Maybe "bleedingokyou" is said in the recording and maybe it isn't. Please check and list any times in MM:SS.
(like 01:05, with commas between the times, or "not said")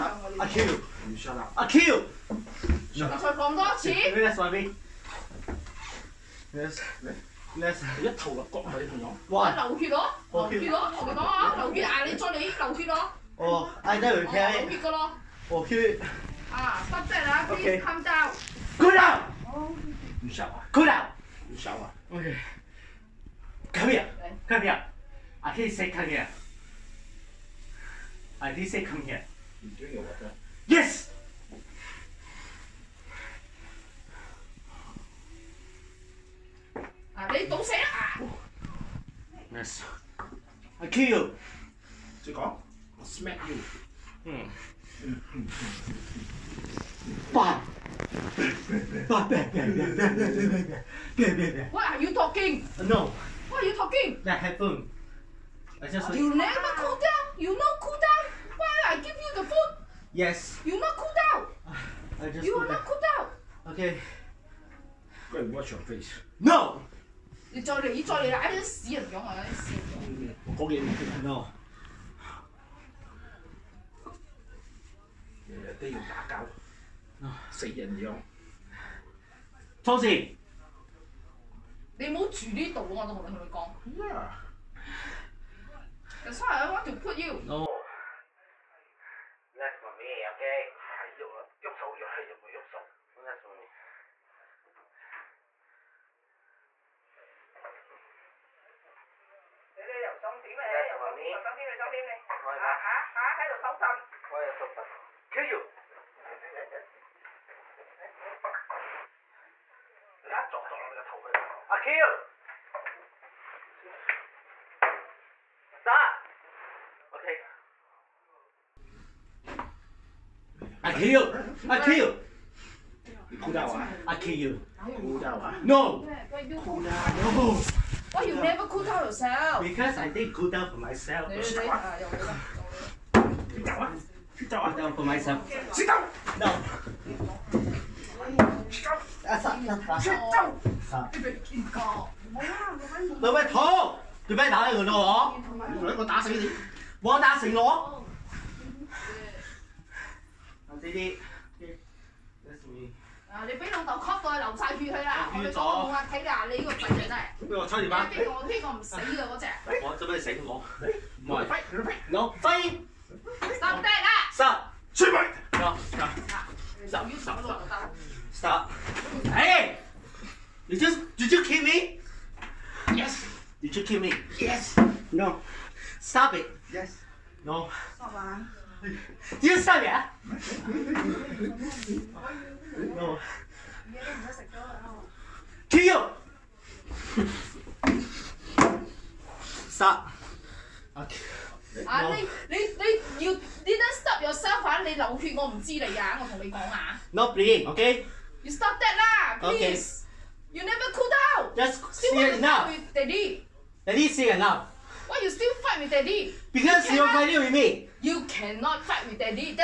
03:17.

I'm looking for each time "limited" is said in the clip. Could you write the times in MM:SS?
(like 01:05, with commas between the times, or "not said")
not said.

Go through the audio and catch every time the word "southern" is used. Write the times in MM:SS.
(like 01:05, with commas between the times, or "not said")
not said.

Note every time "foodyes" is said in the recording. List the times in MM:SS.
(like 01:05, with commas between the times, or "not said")
00:59.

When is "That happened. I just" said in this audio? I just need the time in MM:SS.
00:54.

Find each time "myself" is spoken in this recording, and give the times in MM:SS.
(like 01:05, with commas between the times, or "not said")
02:10, 02:15.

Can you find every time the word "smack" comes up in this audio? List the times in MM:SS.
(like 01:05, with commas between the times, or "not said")
00:43.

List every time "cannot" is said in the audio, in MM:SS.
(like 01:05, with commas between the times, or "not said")
03:28.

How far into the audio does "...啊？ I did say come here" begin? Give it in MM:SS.
00:26.